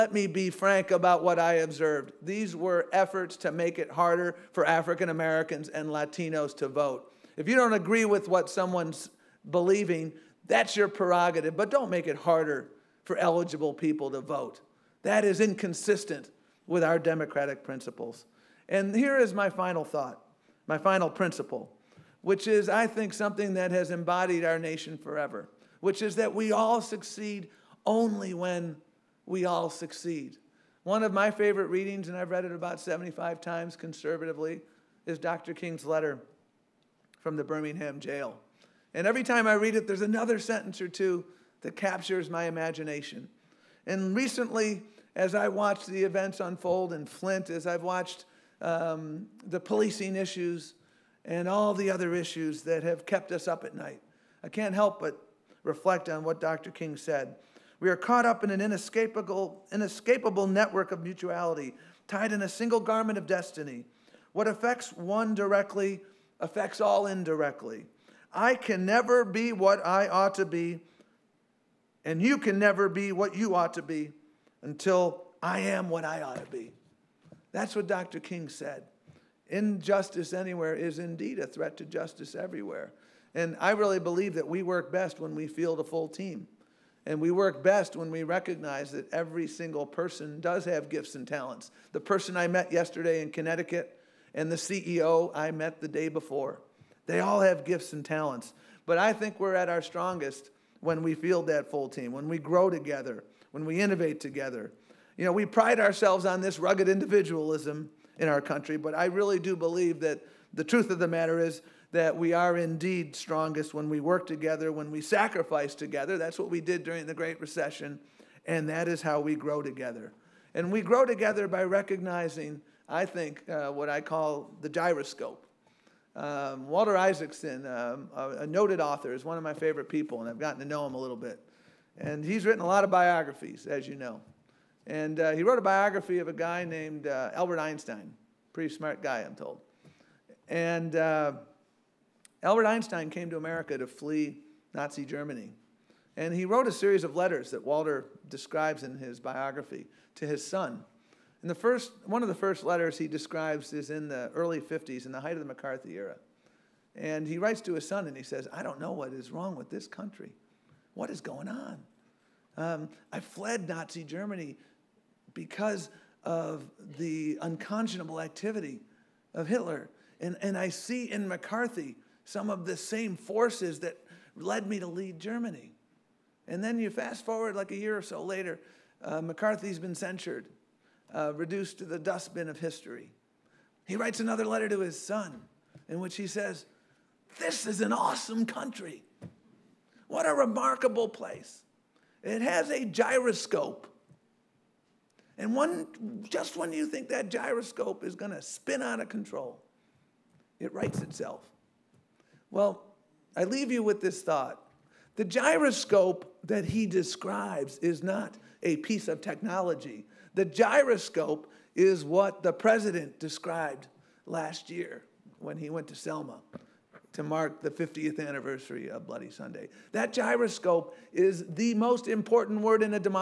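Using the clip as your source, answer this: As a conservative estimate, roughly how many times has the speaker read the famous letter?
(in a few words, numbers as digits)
75.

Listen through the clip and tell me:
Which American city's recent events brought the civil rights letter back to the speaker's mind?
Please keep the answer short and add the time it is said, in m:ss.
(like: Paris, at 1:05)
Flint, at 0:47.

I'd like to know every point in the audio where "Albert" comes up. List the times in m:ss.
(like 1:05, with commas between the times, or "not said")
2:17, 2:22.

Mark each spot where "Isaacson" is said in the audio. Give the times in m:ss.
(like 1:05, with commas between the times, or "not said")
2:06.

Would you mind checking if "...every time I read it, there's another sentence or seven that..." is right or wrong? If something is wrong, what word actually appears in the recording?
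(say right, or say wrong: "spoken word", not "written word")
wrong: "two", not "seven".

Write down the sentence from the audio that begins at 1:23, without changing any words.
And I really believe that we work best when we field a full team.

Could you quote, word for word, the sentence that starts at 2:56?
And then you fast forward like a year or so later, uh, McCarthy's been censured, uh, reduced to the dustbin of history.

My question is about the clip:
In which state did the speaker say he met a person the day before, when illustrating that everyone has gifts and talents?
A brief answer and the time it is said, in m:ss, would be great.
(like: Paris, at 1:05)
Connecticut, at 1:33.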